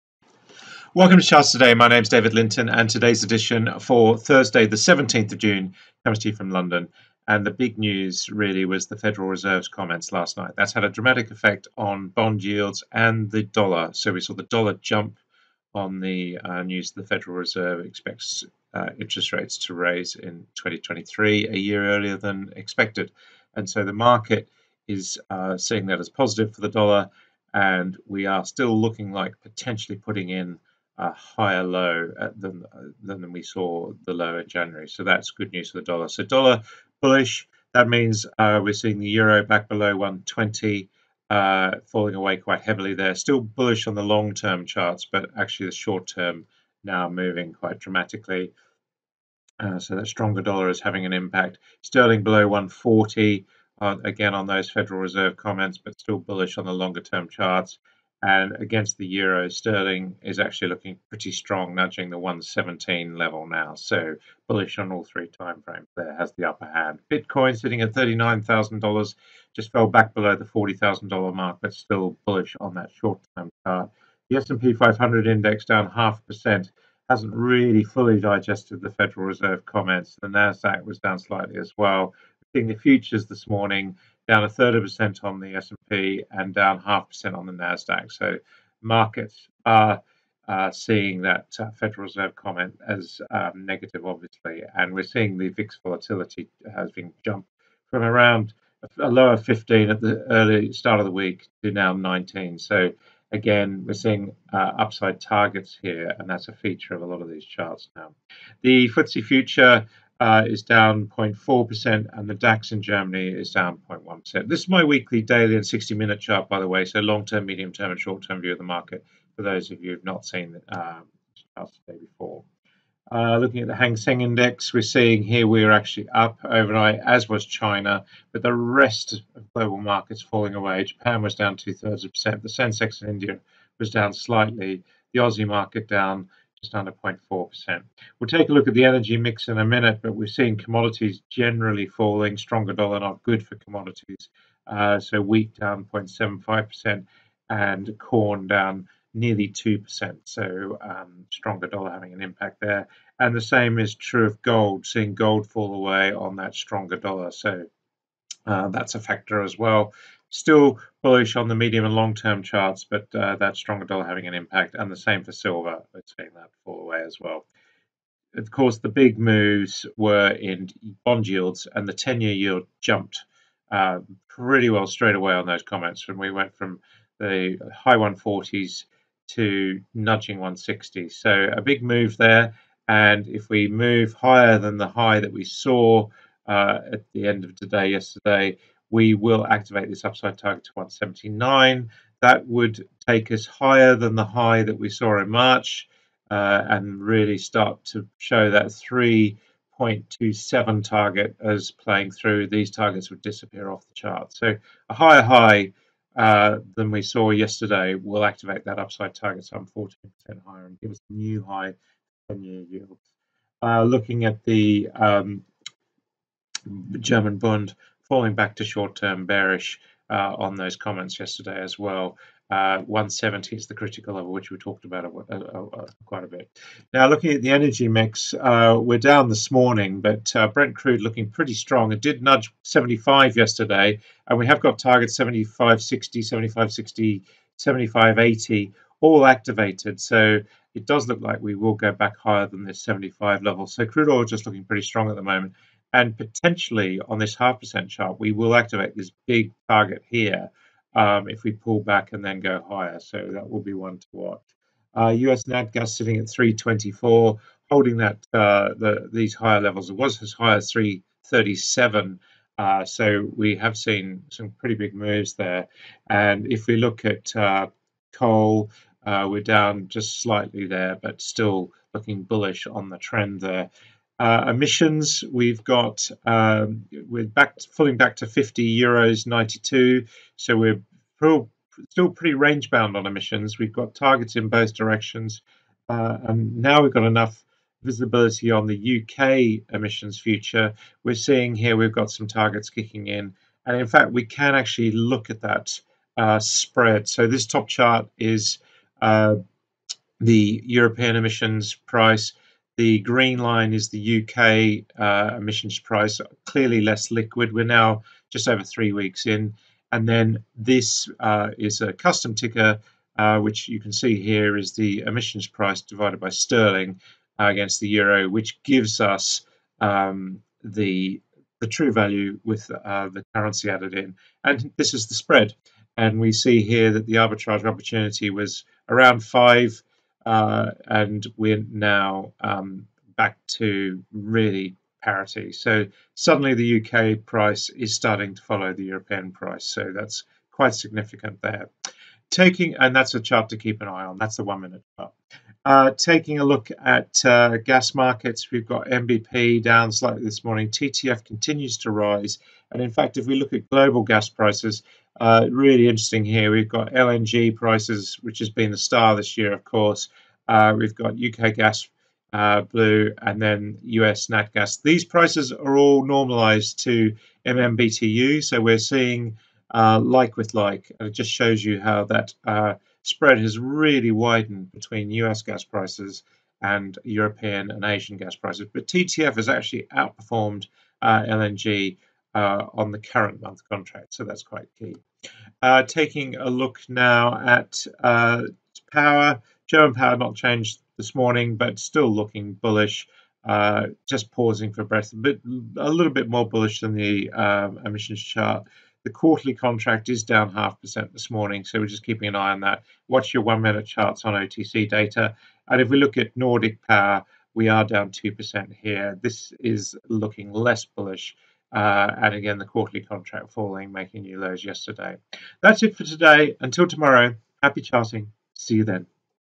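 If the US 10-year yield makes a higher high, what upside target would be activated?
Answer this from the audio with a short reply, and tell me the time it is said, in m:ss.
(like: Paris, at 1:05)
179, at 3:10.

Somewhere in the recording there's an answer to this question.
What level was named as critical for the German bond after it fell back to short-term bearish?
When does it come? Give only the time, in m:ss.
3:42.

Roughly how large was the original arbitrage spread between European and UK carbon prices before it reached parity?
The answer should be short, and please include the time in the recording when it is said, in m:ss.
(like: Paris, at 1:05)
5, at 5:29.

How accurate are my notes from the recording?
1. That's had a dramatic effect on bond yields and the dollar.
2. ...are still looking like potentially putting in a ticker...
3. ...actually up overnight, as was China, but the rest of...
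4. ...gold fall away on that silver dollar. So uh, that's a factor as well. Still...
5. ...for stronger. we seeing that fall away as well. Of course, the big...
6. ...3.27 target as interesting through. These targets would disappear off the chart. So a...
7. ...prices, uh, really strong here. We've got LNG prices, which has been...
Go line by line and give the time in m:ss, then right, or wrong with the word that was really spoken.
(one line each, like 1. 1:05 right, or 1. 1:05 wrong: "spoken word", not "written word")
1. 0:10 right
2. 0:28 wrong: "higher", not "ticker"
3. 2:05 right
4. 2:35 wrong: "stronger", not "silver"
5. 2:45 wrong: "silver", not "stronger"
6. 3:18 wrong: "playing", not "interesting"
7. 5:54 wrong: "interesting", not "strong".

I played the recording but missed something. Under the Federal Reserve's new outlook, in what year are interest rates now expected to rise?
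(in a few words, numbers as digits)
2023.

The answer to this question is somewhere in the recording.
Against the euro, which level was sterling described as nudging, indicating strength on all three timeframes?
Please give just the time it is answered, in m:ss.
1:02.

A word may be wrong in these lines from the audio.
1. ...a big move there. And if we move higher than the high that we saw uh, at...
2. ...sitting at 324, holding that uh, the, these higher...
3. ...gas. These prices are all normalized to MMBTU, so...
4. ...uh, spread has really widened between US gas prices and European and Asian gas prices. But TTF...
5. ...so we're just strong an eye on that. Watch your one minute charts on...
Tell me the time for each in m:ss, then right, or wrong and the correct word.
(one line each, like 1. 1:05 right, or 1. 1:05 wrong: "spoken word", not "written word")
1. 3:01 right
2. 4:15 right
3. 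6:04 right
4. 6:12 right
5. 6:41 wrong: "keeping", not "strong".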